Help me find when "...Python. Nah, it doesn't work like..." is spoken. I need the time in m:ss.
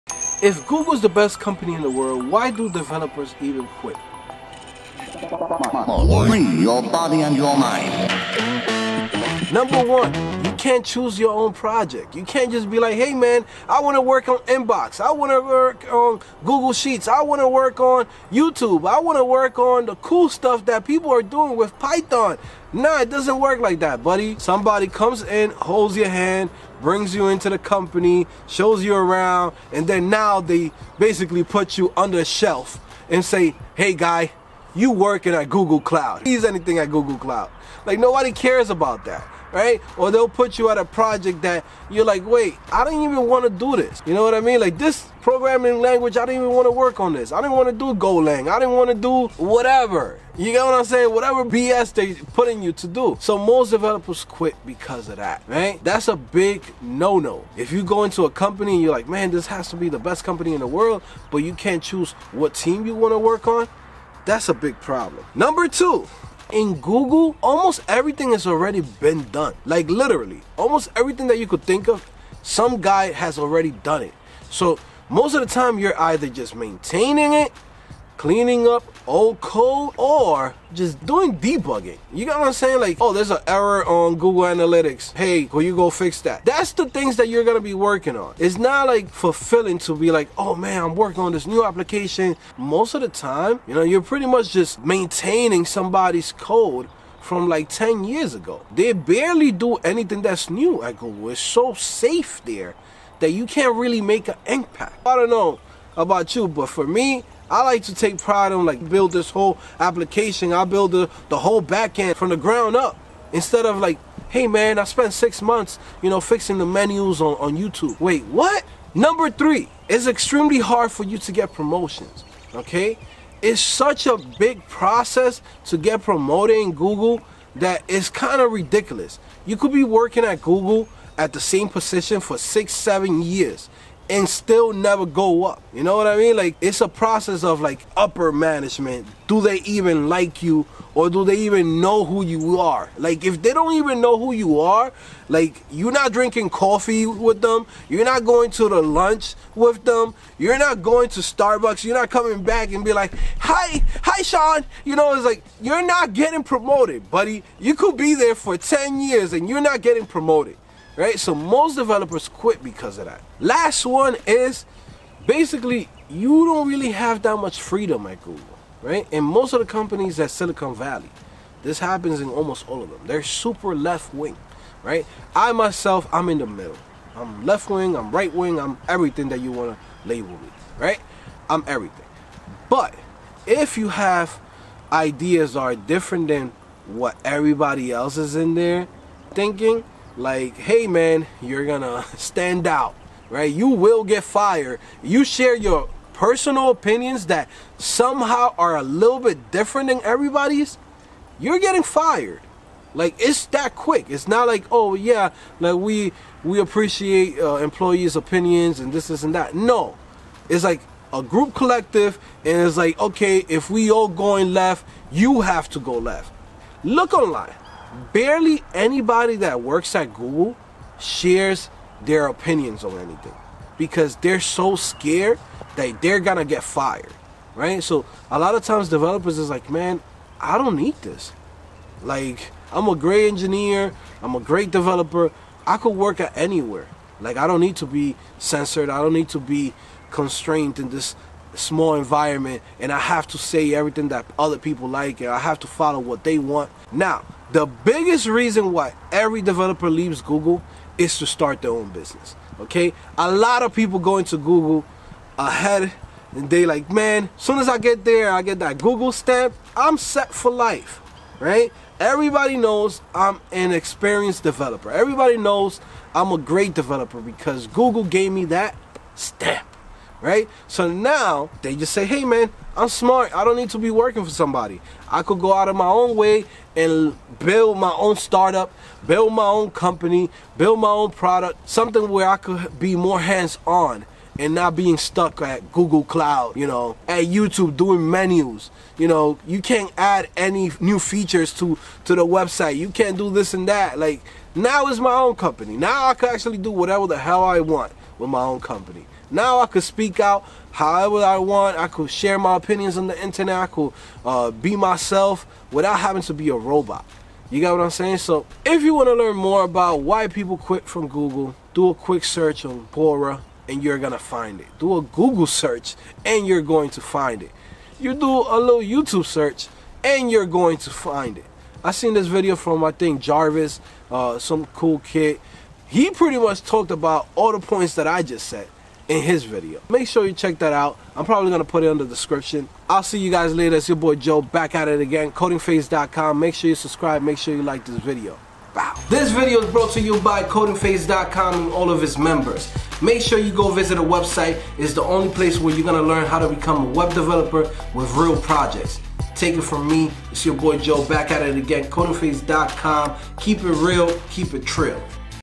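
0:21.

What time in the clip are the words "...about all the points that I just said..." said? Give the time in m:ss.
5:26.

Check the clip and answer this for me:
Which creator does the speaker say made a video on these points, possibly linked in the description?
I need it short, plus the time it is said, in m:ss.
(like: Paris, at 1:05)
Jarvis, at 5:23.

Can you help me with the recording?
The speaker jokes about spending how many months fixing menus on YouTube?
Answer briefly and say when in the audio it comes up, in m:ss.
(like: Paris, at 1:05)
6, at 1:55.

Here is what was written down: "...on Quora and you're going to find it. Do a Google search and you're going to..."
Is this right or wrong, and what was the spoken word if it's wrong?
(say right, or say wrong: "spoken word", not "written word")
right.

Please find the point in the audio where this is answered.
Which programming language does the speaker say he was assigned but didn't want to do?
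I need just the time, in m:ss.
0:47.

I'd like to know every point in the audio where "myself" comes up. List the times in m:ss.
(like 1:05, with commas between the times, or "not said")
2:55, 5:04.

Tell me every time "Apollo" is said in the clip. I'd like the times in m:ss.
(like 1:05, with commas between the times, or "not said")
not said.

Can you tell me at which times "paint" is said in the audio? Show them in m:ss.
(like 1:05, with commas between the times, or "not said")
not said.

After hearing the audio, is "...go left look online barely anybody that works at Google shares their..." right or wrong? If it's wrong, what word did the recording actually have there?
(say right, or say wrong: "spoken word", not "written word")
right.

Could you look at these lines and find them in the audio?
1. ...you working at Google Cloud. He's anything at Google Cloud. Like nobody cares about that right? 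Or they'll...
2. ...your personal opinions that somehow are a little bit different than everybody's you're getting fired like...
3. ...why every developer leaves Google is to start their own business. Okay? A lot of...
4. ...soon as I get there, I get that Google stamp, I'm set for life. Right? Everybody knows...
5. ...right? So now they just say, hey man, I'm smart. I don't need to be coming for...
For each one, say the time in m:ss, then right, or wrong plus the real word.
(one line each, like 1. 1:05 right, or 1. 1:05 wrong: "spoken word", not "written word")
1. 0:34 right
2. 3:15 right
3. 4:08 right
4. 4:17 right
5. 4:30 wrong: "working", not "coming".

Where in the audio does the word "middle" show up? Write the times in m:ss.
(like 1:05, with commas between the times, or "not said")
2:56.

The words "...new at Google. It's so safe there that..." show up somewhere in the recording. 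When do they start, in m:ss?
1:40.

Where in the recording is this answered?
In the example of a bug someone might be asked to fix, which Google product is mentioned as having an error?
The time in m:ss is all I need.
1:24.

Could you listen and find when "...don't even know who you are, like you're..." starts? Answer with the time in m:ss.
2:23.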